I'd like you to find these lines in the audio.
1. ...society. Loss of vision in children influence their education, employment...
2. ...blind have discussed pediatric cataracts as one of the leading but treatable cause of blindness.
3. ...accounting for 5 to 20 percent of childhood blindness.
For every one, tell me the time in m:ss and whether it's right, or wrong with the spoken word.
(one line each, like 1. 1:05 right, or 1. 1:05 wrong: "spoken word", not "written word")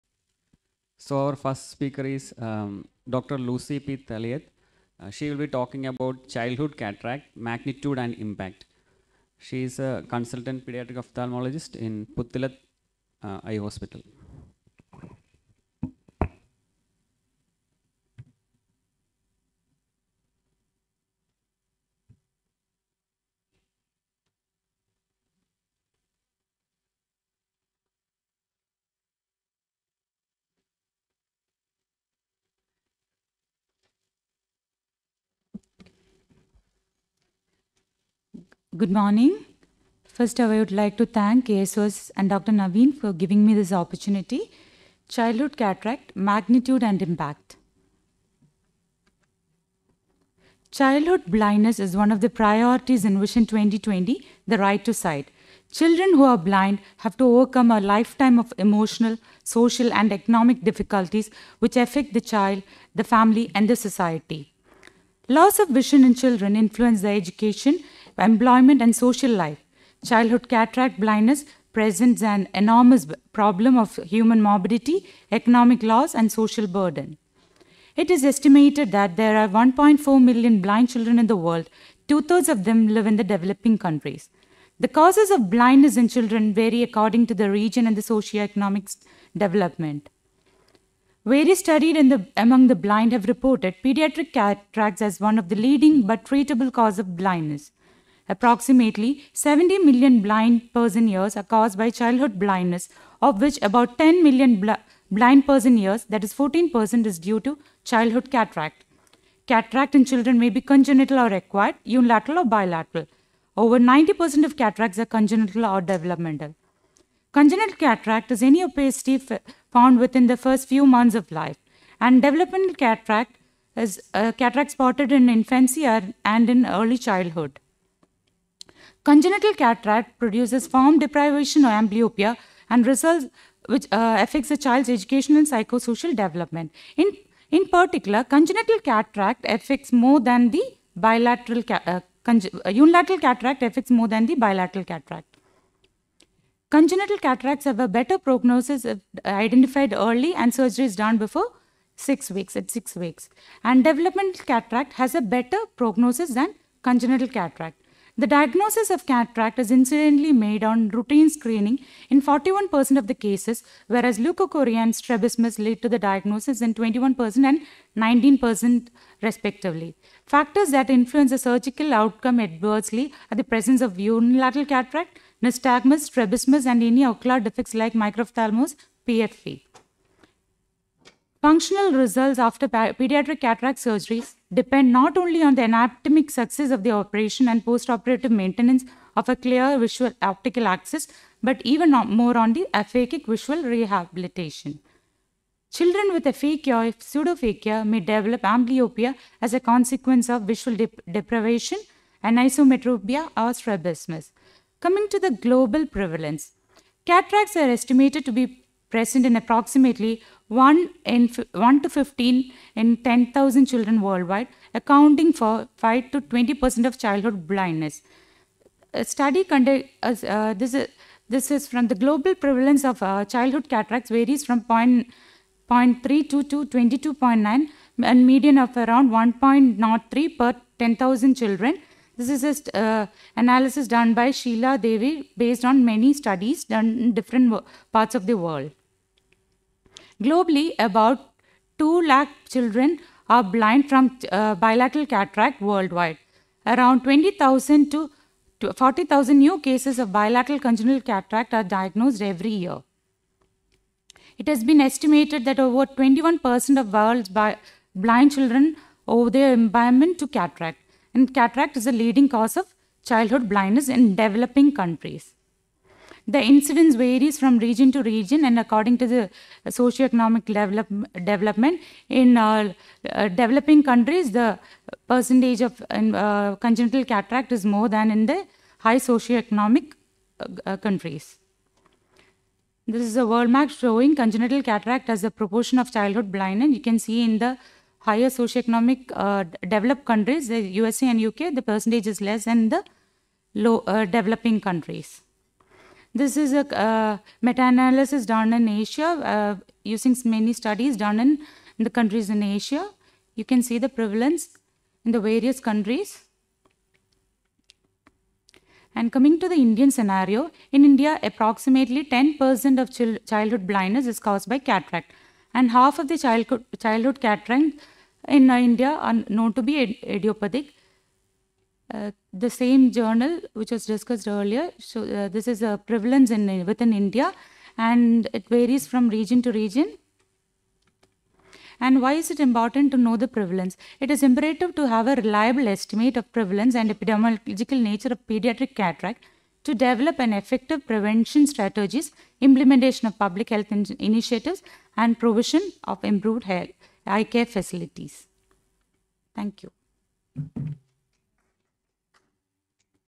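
1. 1:03 right
2. 1:32 wrong: "reported", not "discussed"
3. 3:34 right.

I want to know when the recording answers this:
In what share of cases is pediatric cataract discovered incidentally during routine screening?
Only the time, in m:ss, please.
2:42.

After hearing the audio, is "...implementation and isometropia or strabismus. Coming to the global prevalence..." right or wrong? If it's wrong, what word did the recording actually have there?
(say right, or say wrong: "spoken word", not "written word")
wrong: "deprivation", not "implementation".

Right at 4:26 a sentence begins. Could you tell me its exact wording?
The incidence varies from region to region and according to the socioeconomic develop, development.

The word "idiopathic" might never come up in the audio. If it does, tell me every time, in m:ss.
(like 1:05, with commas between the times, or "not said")
5:20.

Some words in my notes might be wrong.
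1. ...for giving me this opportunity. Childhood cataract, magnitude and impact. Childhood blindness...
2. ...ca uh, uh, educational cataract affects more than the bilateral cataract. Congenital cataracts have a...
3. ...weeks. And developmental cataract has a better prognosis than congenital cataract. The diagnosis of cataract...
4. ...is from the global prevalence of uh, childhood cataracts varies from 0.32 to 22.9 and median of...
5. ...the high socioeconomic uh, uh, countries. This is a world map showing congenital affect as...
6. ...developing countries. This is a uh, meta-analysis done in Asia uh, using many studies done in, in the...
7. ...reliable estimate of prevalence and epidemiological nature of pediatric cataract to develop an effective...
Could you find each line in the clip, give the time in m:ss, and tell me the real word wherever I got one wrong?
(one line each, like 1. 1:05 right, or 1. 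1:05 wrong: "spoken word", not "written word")
1. 0:42 right
2. 2:21 wrong: "unilateral", not "educational"
3. 2:32 right
4. 3:41 right
5. 4:38 wrong: "cataract", not "affect"
6. 4:54 right
7. 5:35 right.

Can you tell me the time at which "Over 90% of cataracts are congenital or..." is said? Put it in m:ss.
1:53.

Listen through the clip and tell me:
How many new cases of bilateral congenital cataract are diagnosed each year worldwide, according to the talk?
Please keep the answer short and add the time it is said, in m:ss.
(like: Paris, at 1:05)
20,000 to 40,000, at 4:07.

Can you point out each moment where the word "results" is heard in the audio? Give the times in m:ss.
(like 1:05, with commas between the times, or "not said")
2:12, 3:01.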